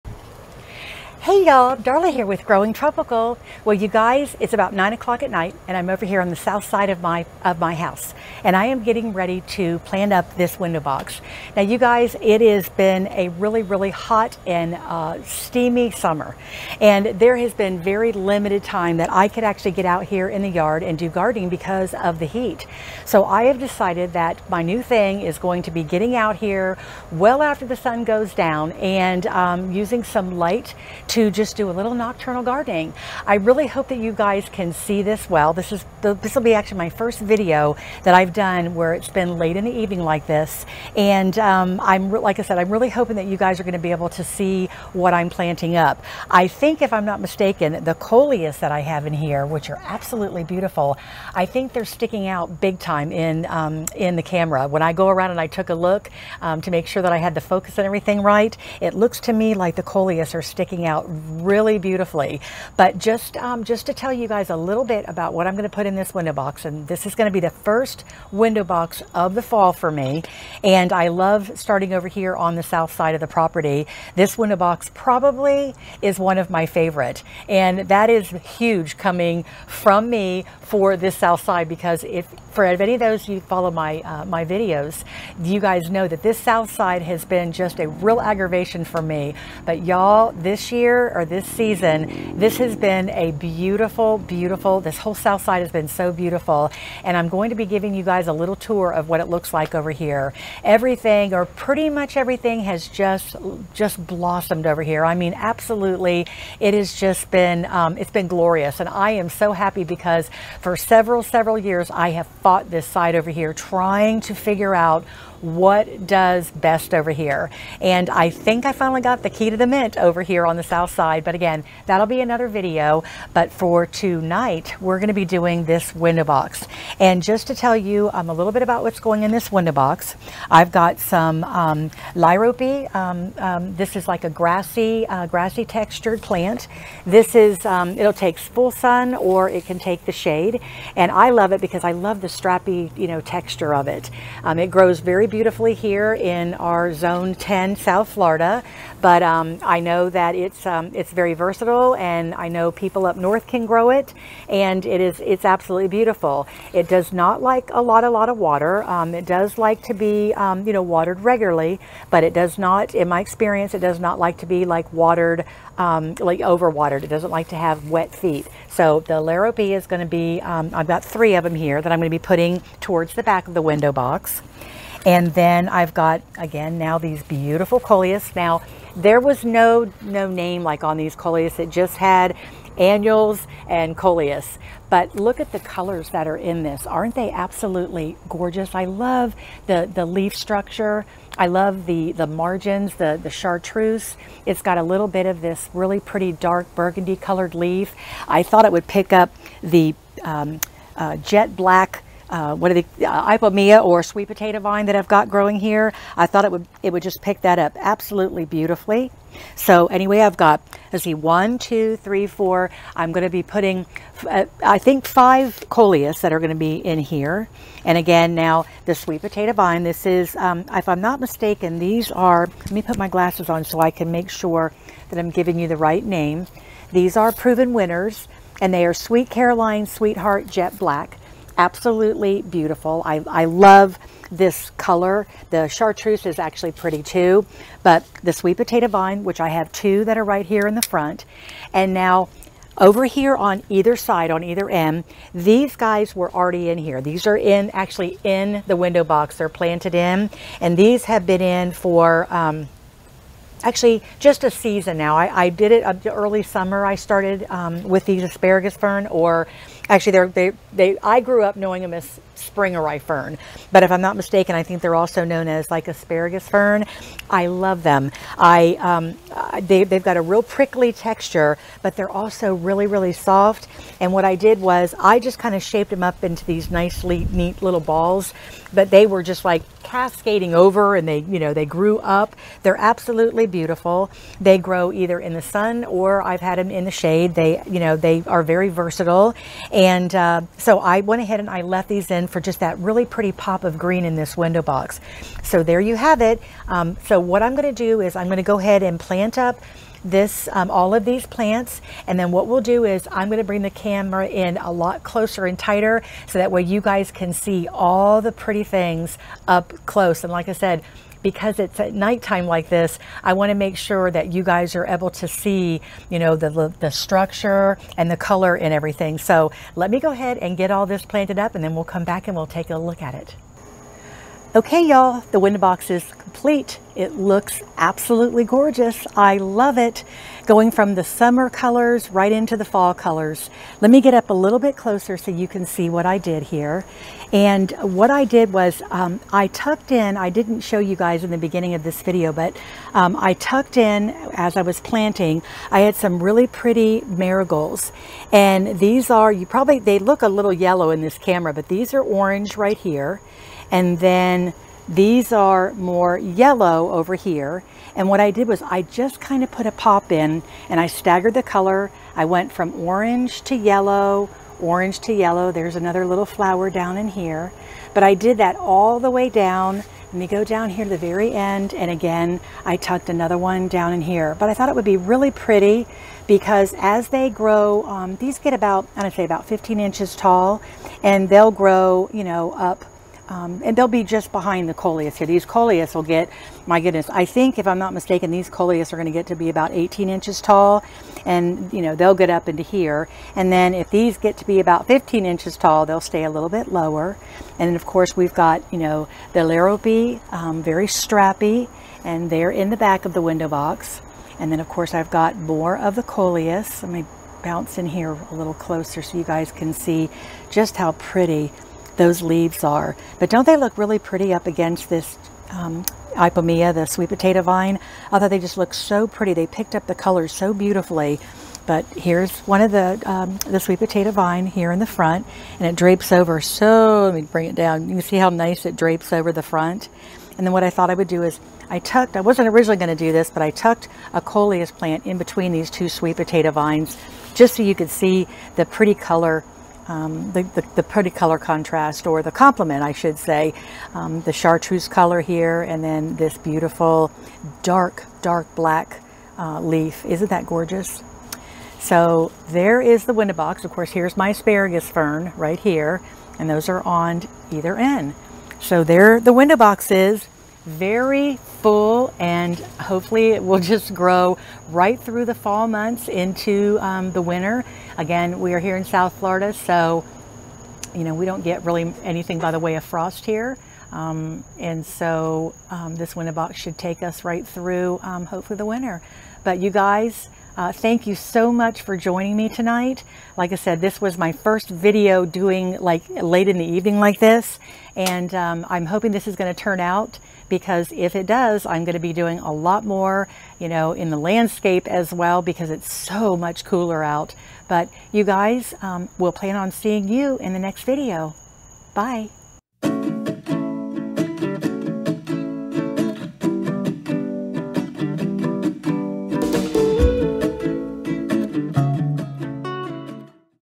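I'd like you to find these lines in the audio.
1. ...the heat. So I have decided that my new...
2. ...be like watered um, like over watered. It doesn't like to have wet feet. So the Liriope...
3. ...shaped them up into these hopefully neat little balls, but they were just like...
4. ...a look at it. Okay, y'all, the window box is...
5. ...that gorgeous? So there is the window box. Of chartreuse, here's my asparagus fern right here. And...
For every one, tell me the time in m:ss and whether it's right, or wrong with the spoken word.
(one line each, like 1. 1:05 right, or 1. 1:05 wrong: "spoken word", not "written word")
1. 0:22 right
2. 2:44 right
3. 4:35 wrong: "nicely", not "hopefully"
4. 5:22 right
5. 7:30 wrong: "course", not "chartreuse".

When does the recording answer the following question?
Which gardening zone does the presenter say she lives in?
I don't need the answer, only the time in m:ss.
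2:26.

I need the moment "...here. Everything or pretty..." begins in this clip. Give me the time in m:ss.
1:39.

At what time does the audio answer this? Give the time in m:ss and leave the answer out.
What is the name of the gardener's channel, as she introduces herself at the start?
0:02.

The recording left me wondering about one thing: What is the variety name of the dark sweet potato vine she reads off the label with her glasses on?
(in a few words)
Sweet Caroline Sweetheart Jet Black.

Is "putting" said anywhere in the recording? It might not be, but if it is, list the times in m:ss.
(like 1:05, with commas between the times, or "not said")
2:52, 3:33.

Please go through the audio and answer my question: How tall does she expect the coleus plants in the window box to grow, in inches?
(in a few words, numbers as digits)
18 inches.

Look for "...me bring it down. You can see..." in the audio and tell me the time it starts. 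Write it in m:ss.
7:07.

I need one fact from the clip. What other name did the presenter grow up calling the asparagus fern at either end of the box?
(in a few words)
Spring fern.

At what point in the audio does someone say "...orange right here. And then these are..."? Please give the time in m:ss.
5:52.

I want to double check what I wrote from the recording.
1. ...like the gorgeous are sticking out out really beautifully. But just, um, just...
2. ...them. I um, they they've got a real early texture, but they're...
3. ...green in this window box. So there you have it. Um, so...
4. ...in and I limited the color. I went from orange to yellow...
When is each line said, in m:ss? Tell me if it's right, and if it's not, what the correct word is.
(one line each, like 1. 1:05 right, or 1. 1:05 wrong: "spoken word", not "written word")
1. 0:59 wrong: "coleus", not "gorgeous"
2. 4:27 wrong: "prickly", not "early"
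3. 4:53 right
4. 6:00 wrong: "staggered", not "limited".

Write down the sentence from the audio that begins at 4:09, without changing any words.
They're planted in, and these have been in for, um, actually just a season now.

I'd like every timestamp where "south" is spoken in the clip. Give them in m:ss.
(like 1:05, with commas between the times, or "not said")
0:06, 1:12, 1:21, 1:26, 1:35, 2:00, 2:27, 7:48.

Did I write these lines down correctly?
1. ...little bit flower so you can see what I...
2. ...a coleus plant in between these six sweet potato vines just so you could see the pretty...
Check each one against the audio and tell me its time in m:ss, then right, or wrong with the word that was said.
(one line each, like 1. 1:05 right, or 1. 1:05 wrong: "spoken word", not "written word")
1. 5:34 wrong: "closer", not "flower"
2. 7:14 wrong: "two", not "six".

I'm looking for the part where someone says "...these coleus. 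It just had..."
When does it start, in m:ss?
3:00.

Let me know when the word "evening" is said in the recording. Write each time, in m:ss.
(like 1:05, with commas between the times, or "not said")
0:39, 8:06.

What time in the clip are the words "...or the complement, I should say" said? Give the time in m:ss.
7:22.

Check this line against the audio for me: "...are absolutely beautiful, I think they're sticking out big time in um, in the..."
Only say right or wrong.
right.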